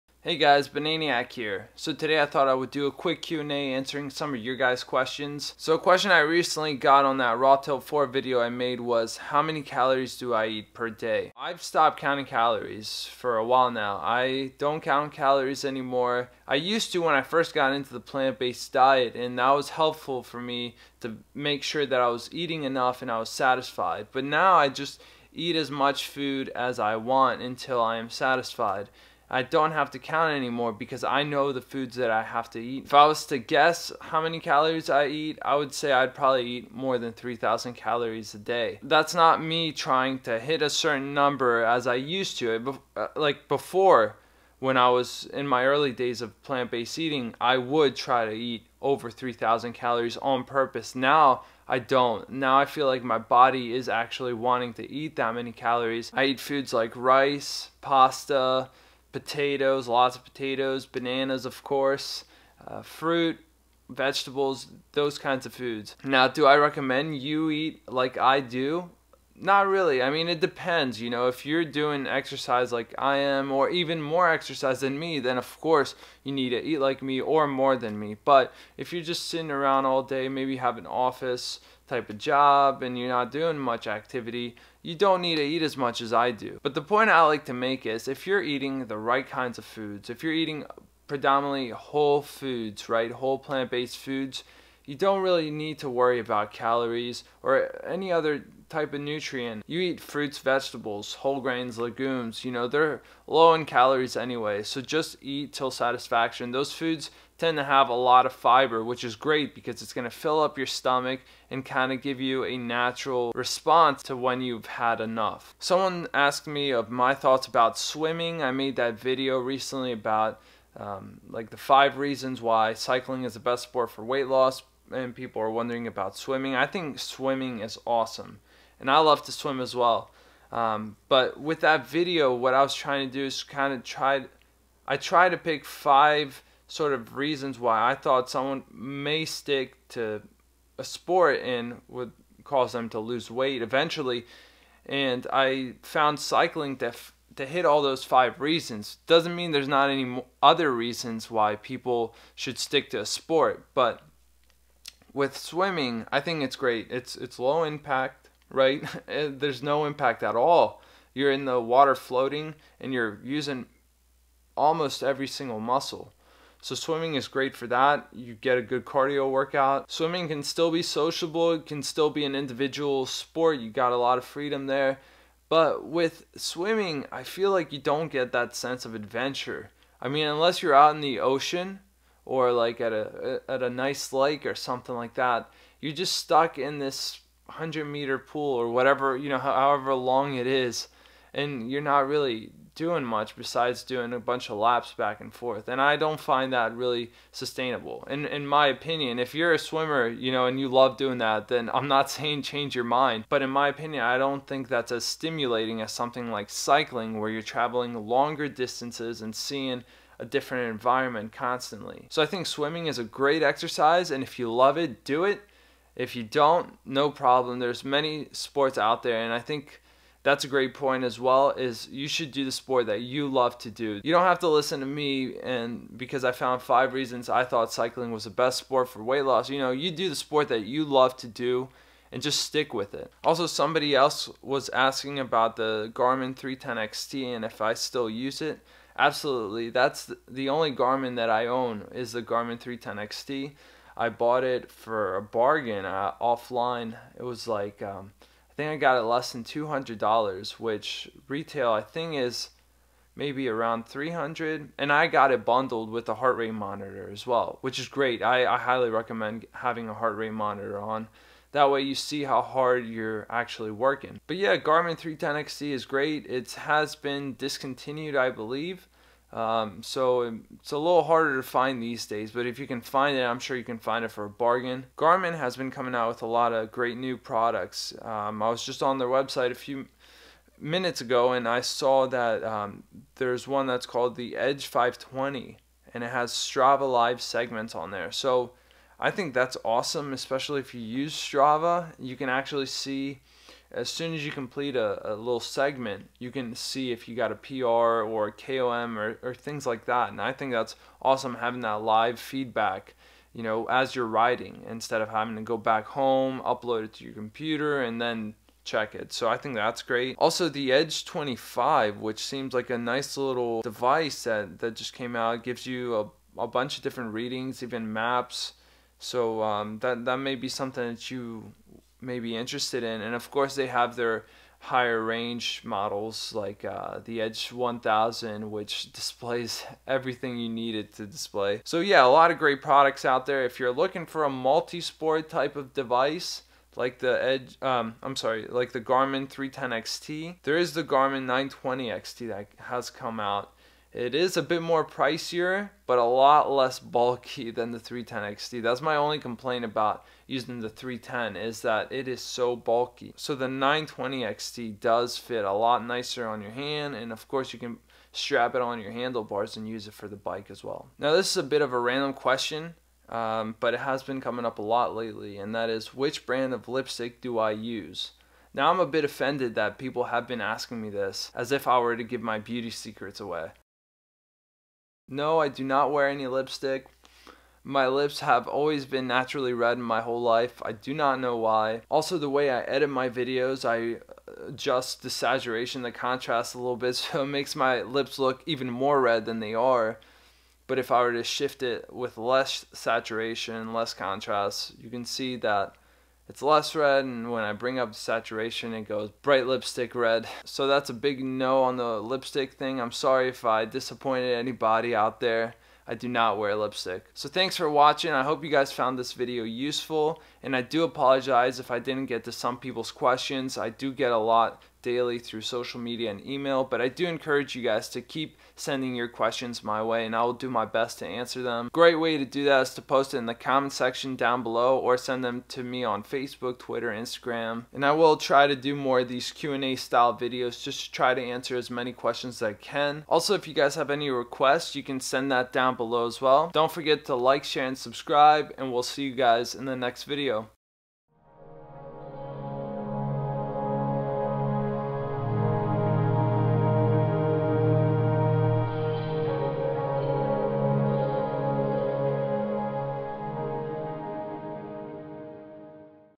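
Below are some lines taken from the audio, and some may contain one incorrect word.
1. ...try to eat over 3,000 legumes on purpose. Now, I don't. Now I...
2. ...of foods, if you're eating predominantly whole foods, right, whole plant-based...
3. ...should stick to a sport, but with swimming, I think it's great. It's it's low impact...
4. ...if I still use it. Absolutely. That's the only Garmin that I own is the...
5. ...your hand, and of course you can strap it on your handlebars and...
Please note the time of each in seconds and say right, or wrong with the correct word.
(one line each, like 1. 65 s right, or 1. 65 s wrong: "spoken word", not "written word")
1. 47 s wrong: "calories", not "legumes"
2. 89 s right
3. 152 s right
4. 237 s right
5. 356 s right.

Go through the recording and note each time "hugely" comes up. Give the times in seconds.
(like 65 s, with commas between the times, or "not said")
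not said.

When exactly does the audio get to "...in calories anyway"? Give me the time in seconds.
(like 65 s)
103 s.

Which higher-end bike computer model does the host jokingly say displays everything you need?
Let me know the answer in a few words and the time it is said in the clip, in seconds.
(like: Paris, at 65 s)
Edge 1000, at 327 s.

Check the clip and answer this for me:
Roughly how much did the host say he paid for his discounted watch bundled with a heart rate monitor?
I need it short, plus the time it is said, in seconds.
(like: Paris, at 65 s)
less than $200, at 249 s.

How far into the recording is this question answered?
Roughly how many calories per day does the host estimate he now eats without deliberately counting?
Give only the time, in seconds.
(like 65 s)
36 s.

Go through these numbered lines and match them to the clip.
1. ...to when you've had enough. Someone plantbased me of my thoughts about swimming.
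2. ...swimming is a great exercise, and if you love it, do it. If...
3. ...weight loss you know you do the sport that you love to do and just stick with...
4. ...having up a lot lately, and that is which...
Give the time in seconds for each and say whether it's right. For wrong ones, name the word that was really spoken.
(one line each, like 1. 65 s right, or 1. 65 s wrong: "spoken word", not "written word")
1. 114 s wrong: "asked", not "plantbased"
2. 212 s right
3. 229 s right
4. 364 s wrong: "coming", not "having".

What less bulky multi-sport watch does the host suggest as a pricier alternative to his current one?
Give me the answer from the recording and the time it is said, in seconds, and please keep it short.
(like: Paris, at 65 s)
Garmin 920 XT, at 340 s.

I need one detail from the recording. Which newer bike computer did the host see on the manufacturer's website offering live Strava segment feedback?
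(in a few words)
Edge 520.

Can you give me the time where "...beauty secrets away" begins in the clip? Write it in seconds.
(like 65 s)
372 s.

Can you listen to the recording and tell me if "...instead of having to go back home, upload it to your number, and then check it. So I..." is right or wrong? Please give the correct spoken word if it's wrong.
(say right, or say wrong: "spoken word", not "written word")
wrong: "computer", not "number".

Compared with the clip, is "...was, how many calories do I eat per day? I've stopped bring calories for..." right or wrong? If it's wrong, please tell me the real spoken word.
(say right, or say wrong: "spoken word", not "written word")
wrong: "counting", not "bring".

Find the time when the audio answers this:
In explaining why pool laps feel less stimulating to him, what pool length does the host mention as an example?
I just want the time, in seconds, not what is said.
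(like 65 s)
187 s.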